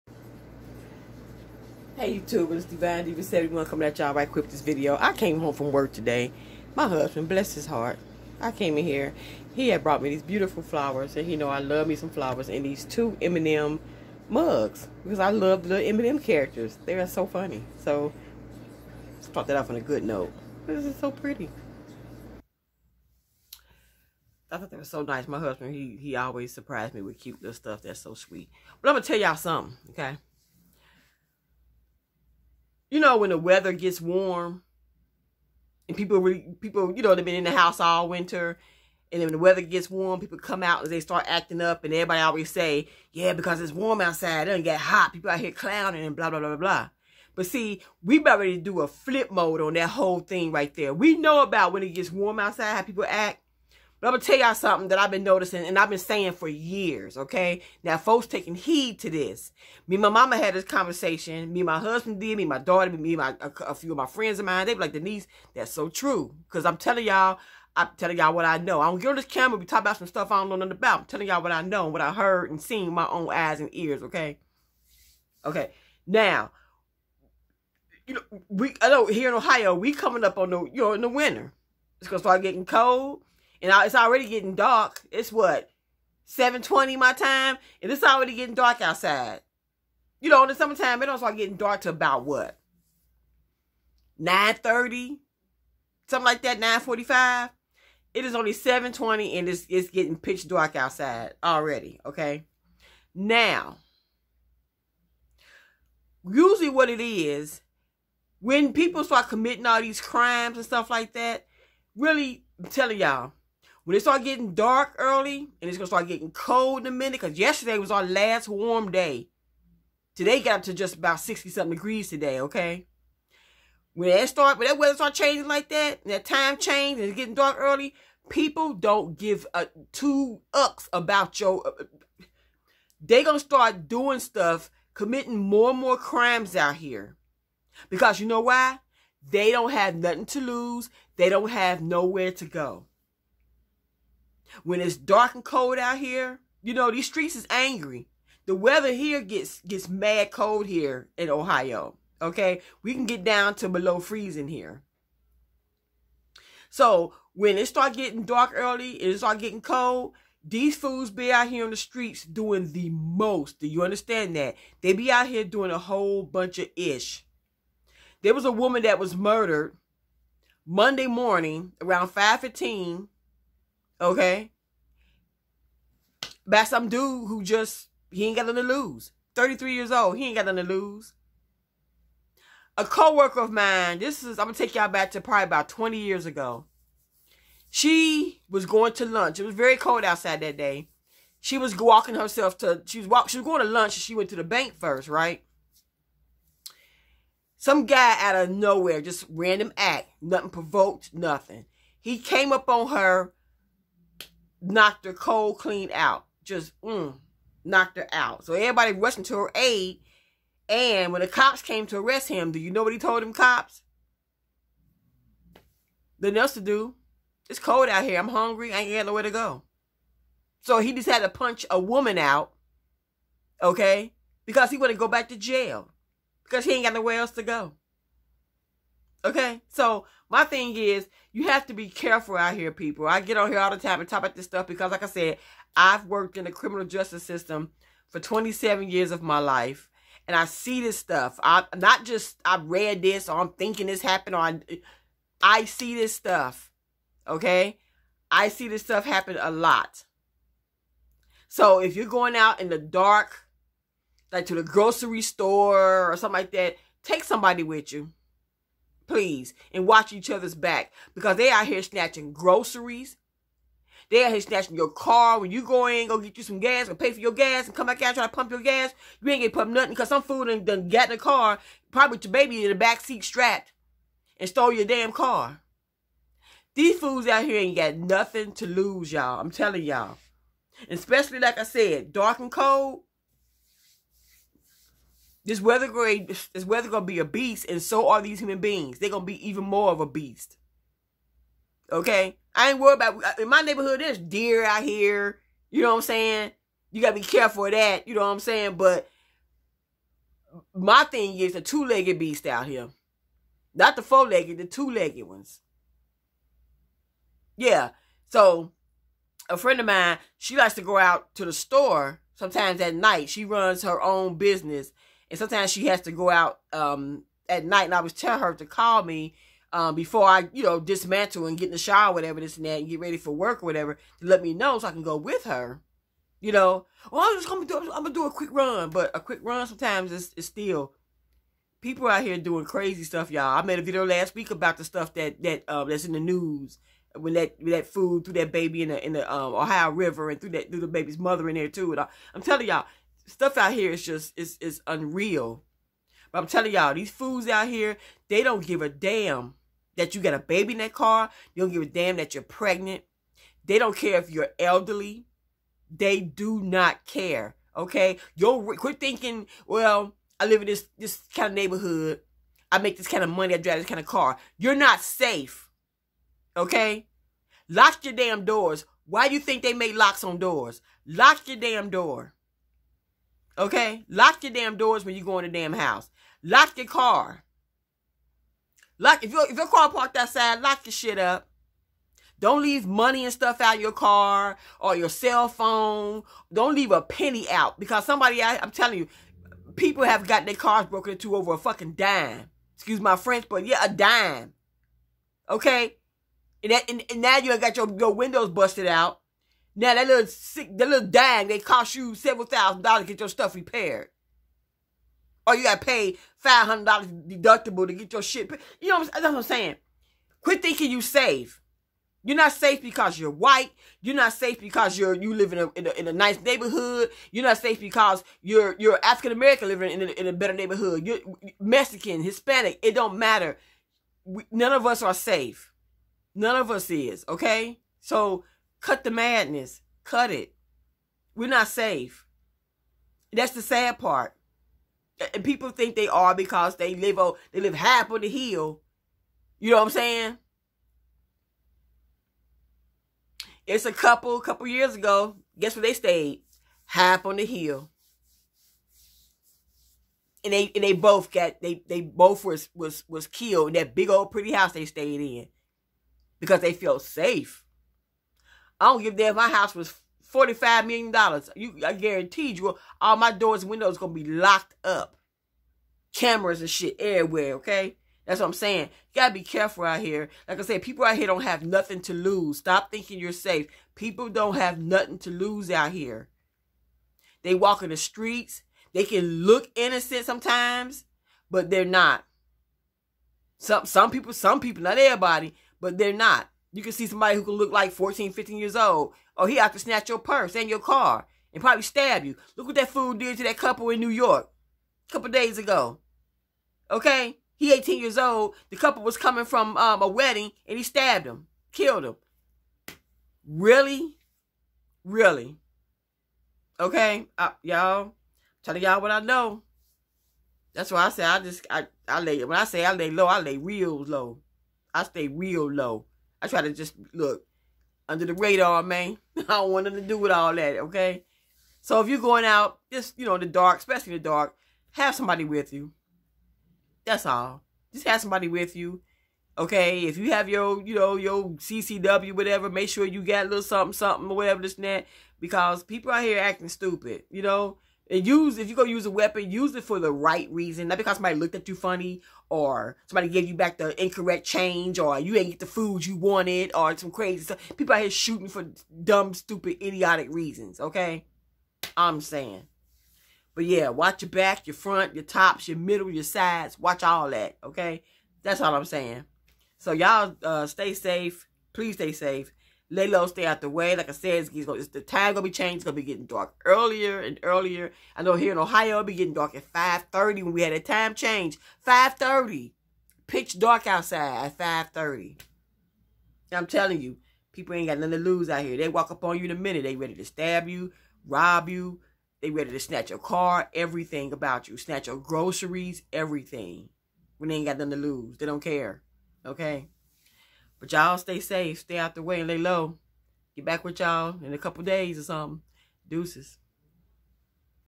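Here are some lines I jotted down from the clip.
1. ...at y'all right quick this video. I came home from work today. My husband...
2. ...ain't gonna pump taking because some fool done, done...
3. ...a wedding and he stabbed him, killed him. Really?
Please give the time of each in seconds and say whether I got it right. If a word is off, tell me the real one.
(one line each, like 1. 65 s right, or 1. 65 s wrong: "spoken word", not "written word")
1. 3 s right
2. 269 s wrong: "nothing", not "taking"
3. 500 s right.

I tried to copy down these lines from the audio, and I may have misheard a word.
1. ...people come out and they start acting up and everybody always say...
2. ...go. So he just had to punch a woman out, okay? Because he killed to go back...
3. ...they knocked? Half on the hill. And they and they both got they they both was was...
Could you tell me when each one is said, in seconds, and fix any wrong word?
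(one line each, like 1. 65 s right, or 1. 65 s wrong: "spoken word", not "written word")
1. 40 s right
2. 219 s wrong: "wanted", not "killed"
3. 445 s wrong: "stayed", not "knocked".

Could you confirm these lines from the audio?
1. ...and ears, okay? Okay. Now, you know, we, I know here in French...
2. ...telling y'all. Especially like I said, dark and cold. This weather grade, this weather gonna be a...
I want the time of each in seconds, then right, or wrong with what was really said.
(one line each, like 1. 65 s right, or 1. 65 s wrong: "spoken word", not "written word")
1. 73 s wrong: "Ohio", not "French"
2. 279 s right.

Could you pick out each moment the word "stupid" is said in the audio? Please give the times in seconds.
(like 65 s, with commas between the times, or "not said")
536 s, 549 s.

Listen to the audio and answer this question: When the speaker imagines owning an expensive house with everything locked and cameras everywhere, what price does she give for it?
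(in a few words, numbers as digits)
45 million dollars.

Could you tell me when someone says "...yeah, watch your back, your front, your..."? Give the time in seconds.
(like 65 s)
553 s.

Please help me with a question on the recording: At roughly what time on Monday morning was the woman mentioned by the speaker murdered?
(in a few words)
5:15.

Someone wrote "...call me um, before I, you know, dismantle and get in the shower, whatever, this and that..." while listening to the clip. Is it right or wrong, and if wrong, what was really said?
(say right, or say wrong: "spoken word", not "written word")
right.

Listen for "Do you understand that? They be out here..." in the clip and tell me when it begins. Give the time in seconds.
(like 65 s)
163 s.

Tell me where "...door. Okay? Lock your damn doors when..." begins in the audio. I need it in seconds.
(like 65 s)
371 s.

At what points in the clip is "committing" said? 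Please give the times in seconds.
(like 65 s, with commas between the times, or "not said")
109 s, 134 s.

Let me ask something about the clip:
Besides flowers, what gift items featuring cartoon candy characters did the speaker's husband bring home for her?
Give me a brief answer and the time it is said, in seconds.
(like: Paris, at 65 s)
M&M mugs, at 13 s.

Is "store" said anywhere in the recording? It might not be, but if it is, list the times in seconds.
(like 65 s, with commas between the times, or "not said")
255 s, 311 s.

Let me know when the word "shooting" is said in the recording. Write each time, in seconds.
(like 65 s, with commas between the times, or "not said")
548 s.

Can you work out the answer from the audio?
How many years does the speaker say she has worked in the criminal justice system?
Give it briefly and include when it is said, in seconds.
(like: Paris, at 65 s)
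27, at 238 s.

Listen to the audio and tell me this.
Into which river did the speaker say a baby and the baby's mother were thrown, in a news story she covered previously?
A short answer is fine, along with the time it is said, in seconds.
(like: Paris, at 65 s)
Ohio River, at 339 s.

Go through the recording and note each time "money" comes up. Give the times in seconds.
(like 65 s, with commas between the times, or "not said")
363 s, 382 s.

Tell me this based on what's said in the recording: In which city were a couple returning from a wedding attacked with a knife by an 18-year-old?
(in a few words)
New York.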